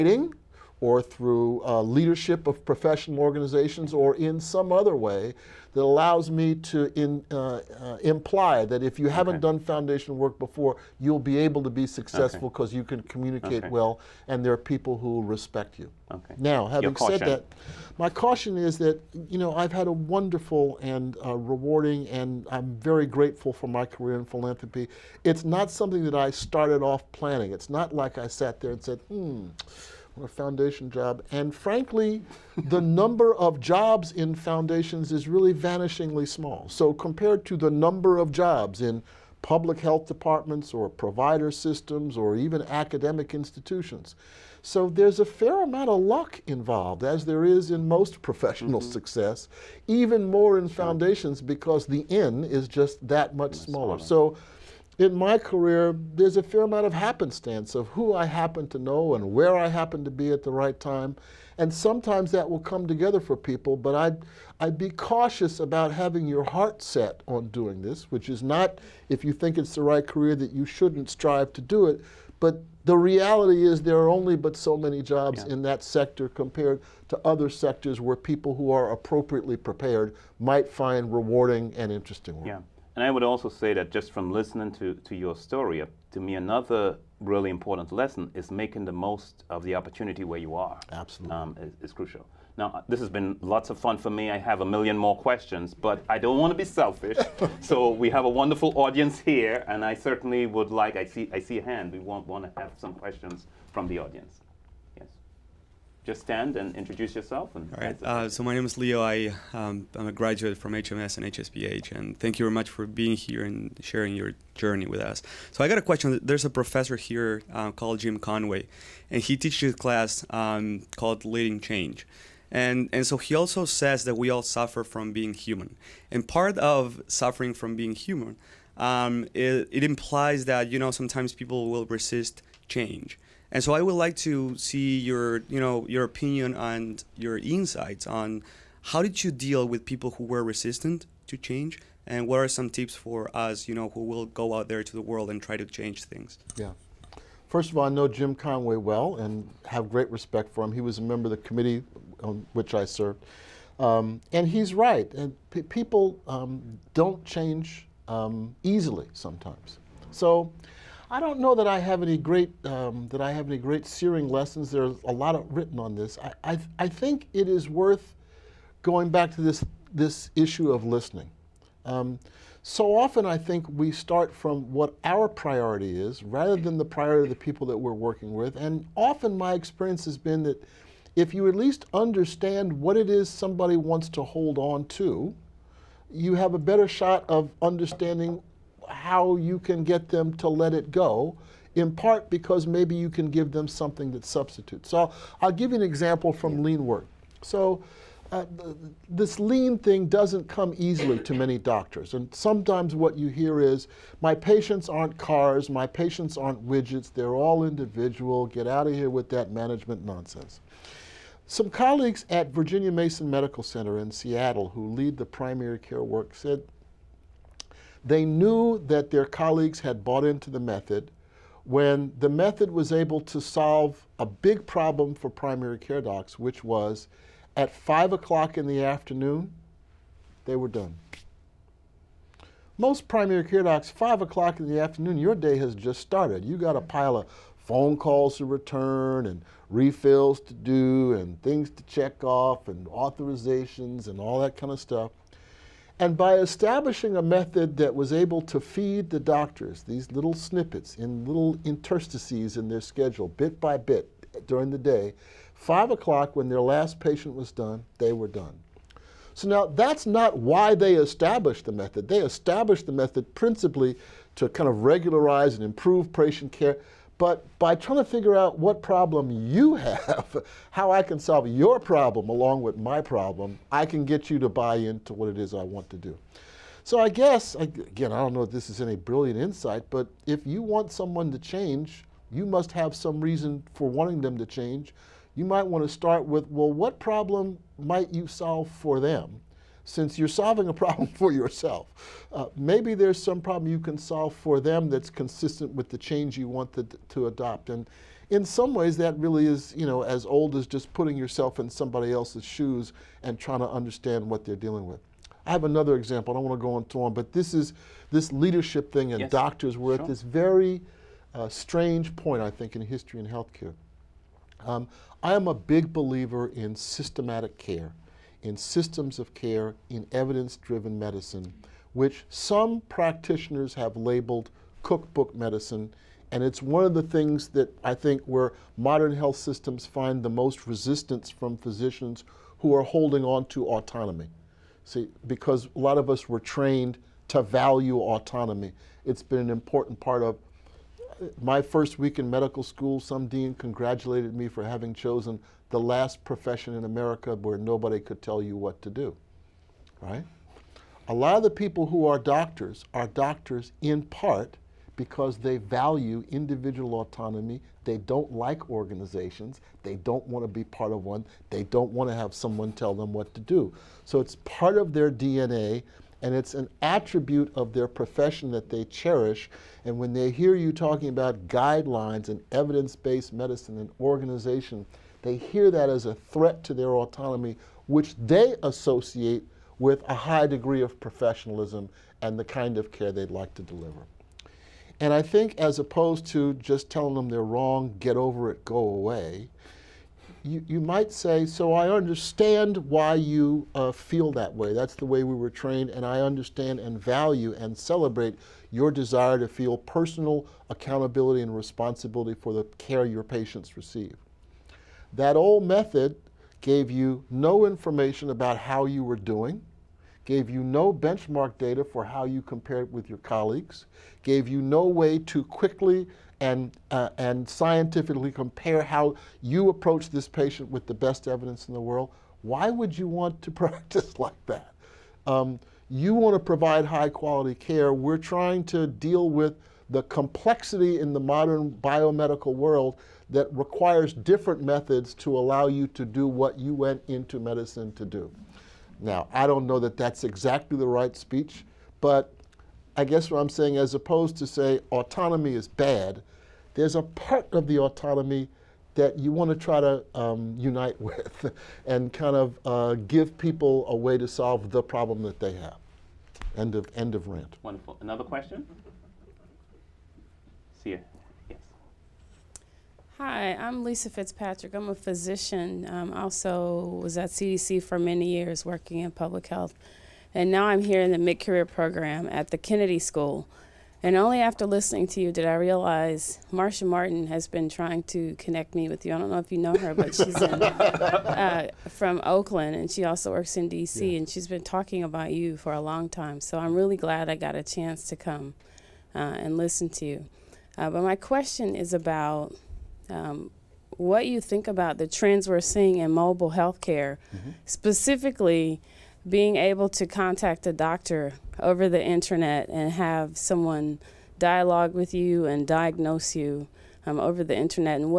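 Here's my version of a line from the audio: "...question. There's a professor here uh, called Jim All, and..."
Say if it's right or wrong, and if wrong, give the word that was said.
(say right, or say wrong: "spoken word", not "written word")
wrong: "Conway", not "All".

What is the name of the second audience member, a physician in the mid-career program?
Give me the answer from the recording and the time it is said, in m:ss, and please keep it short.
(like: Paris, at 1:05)
Lisa Fitzpatrick, at 7:43.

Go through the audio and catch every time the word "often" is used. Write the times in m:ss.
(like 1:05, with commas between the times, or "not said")
2:52, 2:58.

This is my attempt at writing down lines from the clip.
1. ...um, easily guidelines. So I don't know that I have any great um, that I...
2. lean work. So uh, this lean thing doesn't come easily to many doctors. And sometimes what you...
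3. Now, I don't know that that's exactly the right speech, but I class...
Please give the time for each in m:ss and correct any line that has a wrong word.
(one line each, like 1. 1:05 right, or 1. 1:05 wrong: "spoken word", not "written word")
1. 2:38 wrong: "sometimes", not "guidelines"
2. 3:16 right
3. 7:19 wrong: "guess", not "class".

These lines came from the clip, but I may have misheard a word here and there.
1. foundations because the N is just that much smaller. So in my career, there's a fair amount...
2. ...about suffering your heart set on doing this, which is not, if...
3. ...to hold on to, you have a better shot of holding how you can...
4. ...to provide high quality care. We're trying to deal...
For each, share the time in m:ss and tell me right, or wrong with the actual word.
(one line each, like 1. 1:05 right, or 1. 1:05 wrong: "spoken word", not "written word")
1. 0:50 right
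2. 1:05 wrong: "having", not "suffering"
3. 3:04 wrong: "understanding", not "holding"
4. 7:06 right.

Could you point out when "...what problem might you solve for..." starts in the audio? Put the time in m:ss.
4:46.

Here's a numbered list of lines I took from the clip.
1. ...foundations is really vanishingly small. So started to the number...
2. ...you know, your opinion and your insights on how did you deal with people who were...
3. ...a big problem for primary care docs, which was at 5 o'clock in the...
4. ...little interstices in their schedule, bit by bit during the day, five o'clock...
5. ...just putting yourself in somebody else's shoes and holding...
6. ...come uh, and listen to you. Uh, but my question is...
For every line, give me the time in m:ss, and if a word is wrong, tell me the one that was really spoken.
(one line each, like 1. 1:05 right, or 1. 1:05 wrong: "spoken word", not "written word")
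1. 0:34 wrong: "compared", not "started"
2. 2:15 right
3. 3:44 right
4. 4:11 right
5. 5:00 wrong: "trying", not "holding"
6. 8:08 right.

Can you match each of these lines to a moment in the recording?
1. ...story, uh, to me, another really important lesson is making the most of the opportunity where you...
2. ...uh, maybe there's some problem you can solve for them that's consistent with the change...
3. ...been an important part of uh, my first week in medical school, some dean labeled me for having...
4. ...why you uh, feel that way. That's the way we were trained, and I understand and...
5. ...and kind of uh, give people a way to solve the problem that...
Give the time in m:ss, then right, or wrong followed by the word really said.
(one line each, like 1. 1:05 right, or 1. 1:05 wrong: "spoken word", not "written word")
1. 1:25 right
2. 4:52 right
3. 5:39 wrong: "congratulated", not "labeled"
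4. 6:32 right
5. 7:31 right.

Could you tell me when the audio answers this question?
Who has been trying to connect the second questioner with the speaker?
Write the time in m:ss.
7:56.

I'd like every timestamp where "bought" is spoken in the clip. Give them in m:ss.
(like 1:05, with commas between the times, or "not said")
3:40.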